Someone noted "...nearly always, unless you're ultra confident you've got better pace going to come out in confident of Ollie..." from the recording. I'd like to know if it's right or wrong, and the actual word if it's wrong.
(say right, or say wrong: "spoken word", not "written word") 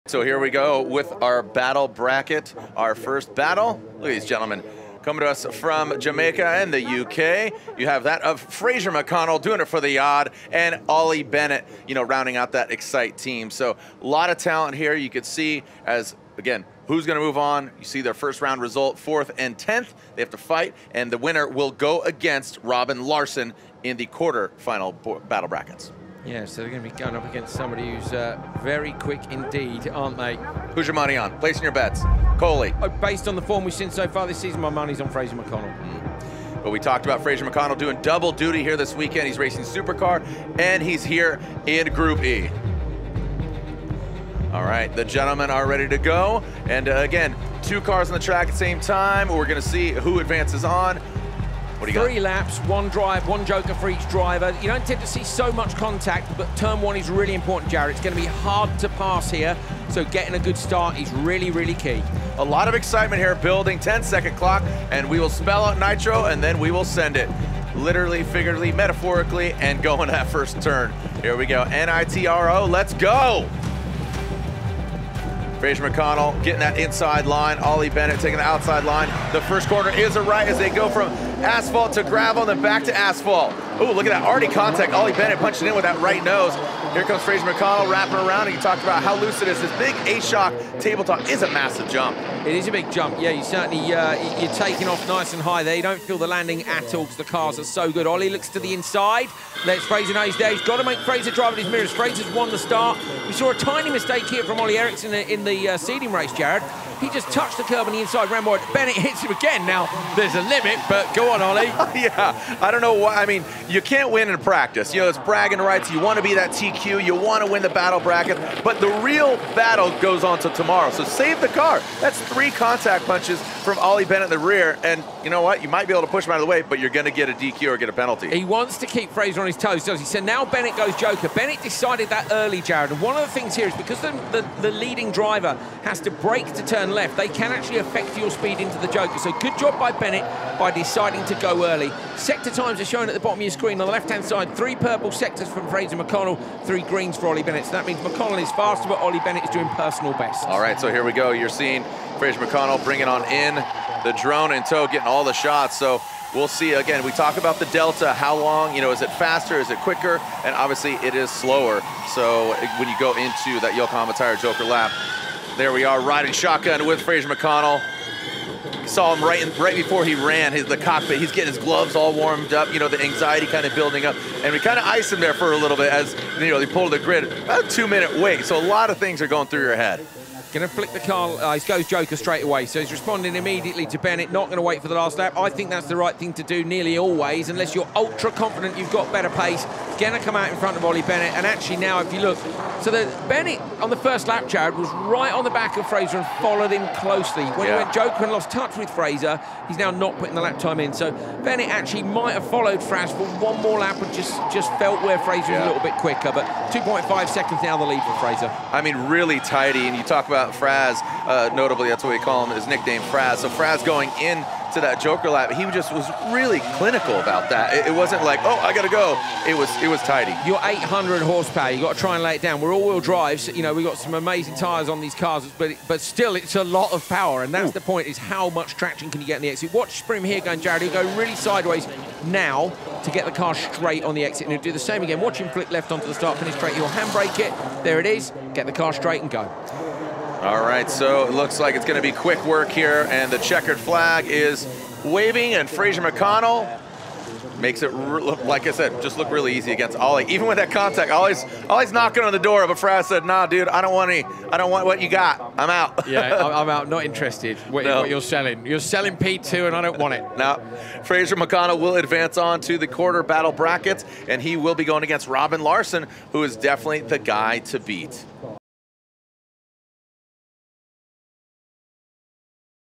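wrong: "front", not "confident".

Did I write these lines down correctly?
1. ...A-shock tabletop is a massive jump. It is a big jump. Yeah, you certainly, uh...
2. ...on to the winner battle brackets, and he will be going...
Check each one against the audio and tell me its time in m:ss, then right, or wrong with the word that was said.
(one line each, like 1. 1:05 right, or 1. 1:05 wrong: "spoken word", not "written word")
1. 1:30 right
2. 4:22 wrong: "quarter", not "winner".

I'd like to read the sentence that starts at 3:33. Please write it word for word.
So Fras going in to that Joker lap.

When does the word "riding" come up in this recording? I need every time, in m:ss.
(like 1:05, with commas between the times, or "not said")
2:46.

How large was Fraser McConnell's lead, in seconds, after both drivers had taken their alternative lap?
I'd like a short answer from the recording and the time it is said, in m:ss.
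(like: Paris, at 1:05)
2.5, at 3:26.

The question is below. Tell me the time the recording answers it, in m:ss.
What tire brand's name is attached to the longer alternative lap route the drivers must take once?
2:43.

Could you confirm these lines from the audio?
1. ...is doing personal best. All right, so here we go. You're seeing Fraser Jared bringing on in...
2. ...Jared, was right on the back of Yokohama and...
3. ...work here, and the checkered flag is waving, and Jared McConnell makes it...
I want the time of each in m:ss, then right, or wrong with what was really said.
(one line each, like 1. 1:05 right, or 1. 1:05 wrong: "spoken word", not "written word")
1. 2:29 wrong: "McConnell", not "Jared"
2. 3:14 wrong: "Fraser", not "Yokohama"
3. 4:02 wrong: "Fraser", not "Jared".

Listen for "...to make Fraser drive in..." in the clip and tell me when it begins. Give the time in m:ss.
1:40.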